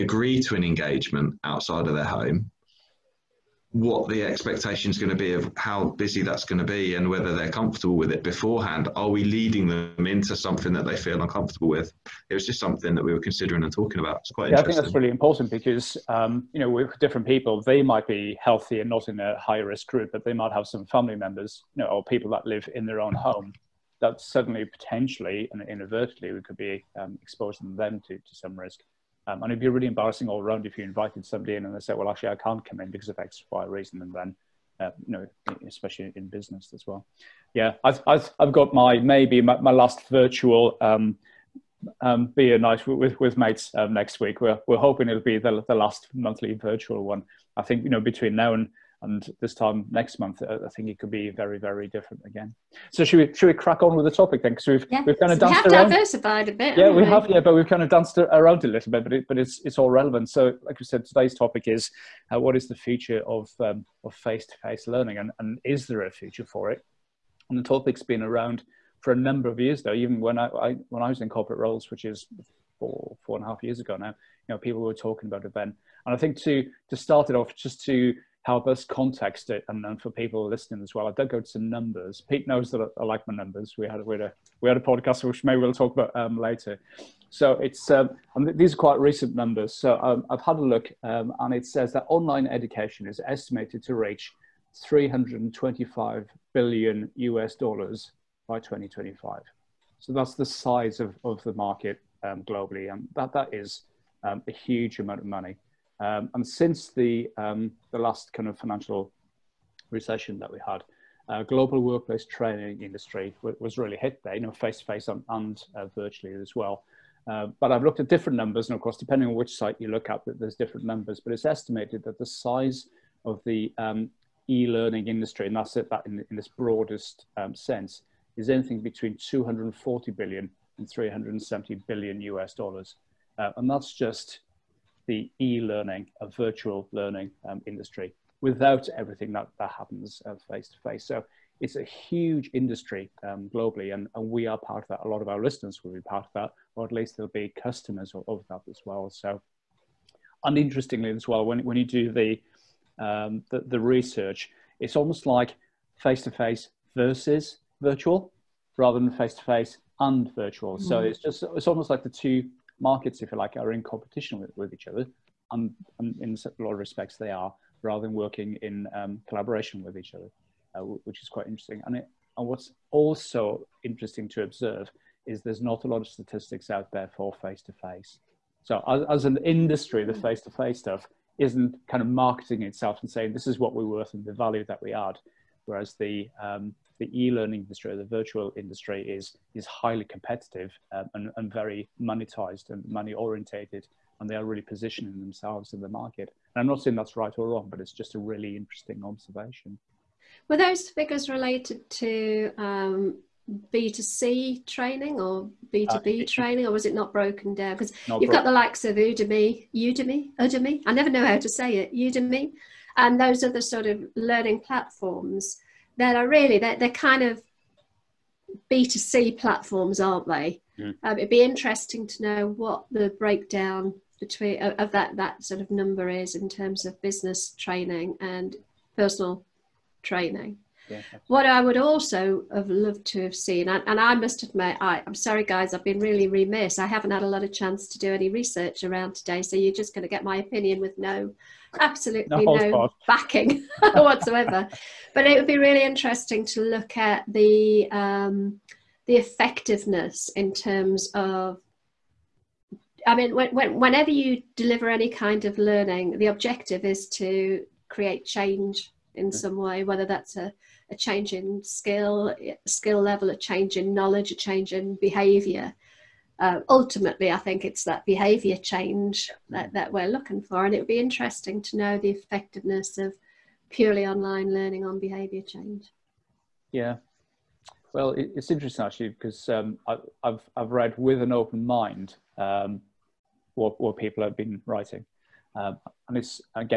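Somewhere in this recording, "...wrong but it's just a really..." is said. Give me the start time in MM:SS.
03:17.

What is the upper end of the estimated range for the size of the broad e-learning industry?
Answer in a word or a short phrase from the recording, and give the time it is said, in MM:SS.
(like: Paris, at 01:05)
370 billion US dollars, at 02:10.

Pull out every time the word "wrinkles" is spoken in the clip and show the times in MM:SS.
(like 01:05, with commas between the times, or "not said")
not said.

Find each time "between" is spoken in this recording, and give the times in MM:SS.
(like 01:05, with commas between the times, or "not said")
00:48, 02:08, 03:44.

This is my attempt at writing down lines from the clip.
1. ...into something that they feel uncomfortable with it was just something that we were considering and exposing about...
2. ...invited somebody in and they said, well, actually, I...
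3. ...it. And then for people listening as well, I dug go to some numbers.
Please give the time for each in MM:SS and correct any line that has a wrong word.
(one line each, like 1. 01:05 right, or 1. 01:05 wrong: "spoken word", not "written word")
1. 00:10 wrong: "talking", not "exposing"
2. 00:30 right
3. 01:19 right.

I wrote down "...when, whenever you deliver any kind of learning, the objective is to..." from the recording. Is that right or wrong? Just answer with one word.
right.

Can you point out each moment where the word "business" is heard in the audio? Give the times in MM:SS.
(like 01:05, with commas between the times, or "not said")
00:36, 03:47.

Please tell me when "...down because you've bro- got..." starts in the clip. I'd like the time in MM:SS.
03:27.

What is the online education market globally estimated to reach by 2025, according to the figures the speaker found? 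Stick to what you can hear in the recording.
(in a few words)
325 billion US dollars.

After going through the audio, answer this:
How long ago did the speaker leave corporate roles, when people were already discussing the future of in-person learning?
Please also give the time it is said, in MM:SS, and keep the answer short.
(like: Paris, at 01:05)
4 and a half years, at 01:12.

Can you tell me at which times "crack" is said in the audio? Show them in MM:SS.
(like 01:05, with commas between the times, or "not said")
00:53.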